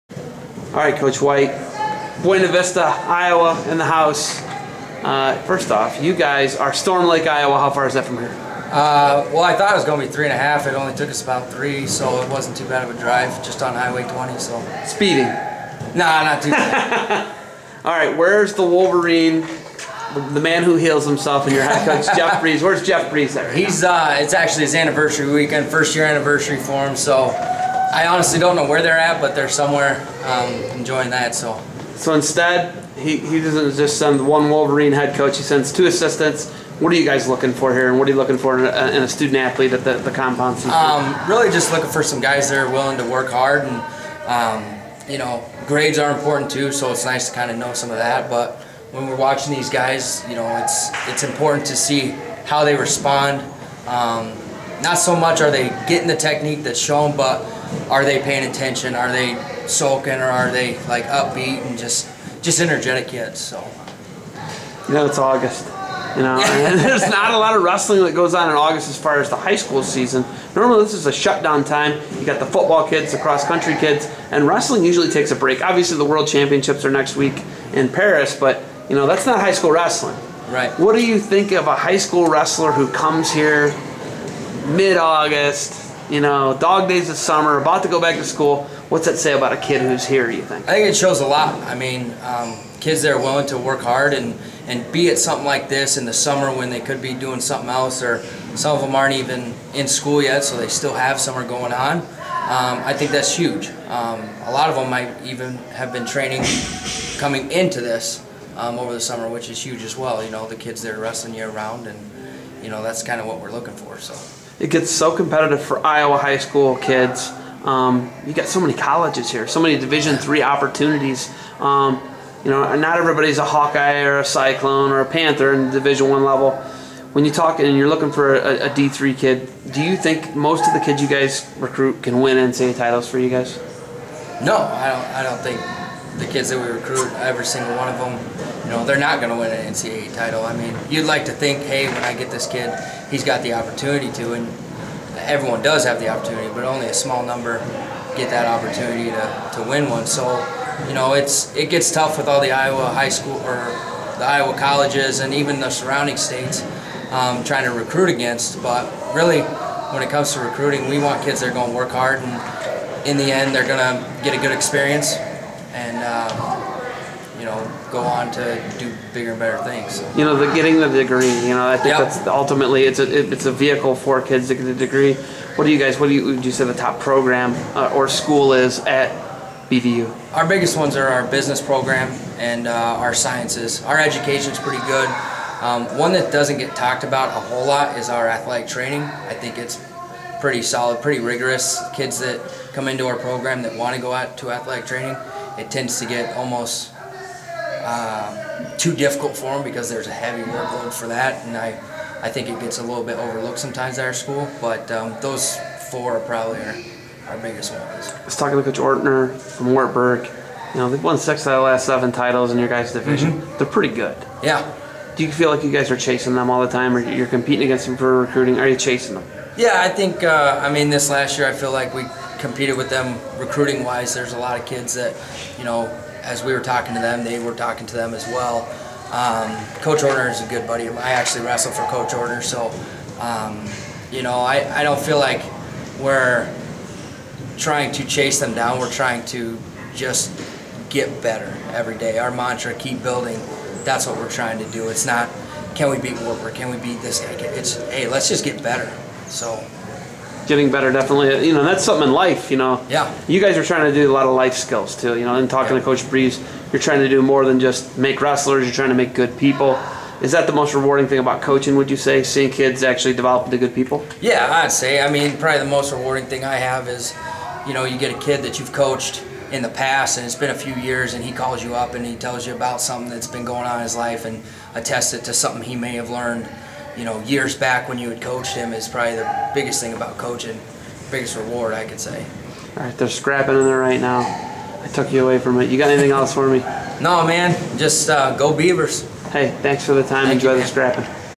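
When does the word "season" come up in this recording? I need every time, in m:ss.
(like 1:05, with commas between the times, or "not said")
1:09.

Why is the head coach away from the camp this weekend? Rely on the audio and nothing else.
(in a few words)
first year anniversary.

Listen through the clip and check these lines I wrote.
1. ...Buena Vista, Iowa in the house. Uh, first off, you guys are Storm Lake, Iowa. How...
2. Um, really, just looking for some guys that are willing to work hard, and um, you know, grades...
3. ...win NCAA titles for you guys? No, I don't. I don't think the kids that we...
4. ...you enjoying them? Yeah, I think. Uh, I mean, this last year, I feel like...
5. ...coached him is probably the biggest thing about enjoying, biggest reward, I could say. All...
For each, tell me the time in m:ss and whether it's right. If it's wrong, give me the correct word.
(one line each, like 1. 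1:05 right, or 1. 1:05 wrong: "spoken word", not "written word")
1. 0:02 right
2. 0:40 right
3. 2:12 right
4. 3:38 wrong: "chasing", not "enjoying"
5. 4:38 wrong: "coaching", not "enjoying".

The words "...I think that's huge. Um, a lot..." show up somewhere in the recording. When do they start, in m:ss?
1:42.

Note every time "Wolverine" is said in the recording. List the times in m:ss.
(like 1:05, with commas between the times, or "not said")
0:18, 0:34.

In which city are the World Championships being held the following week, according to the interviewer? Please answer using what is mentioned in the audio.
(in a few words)
Paris.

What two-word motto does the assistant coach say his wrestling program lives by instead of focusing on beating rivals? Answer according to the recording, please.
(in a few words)
keep building.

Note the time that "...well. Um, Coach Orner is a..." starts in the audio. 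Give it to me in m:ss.
3:48.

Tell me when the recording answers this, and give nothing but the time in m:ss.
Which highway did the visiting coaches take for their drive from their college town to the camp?
0:13.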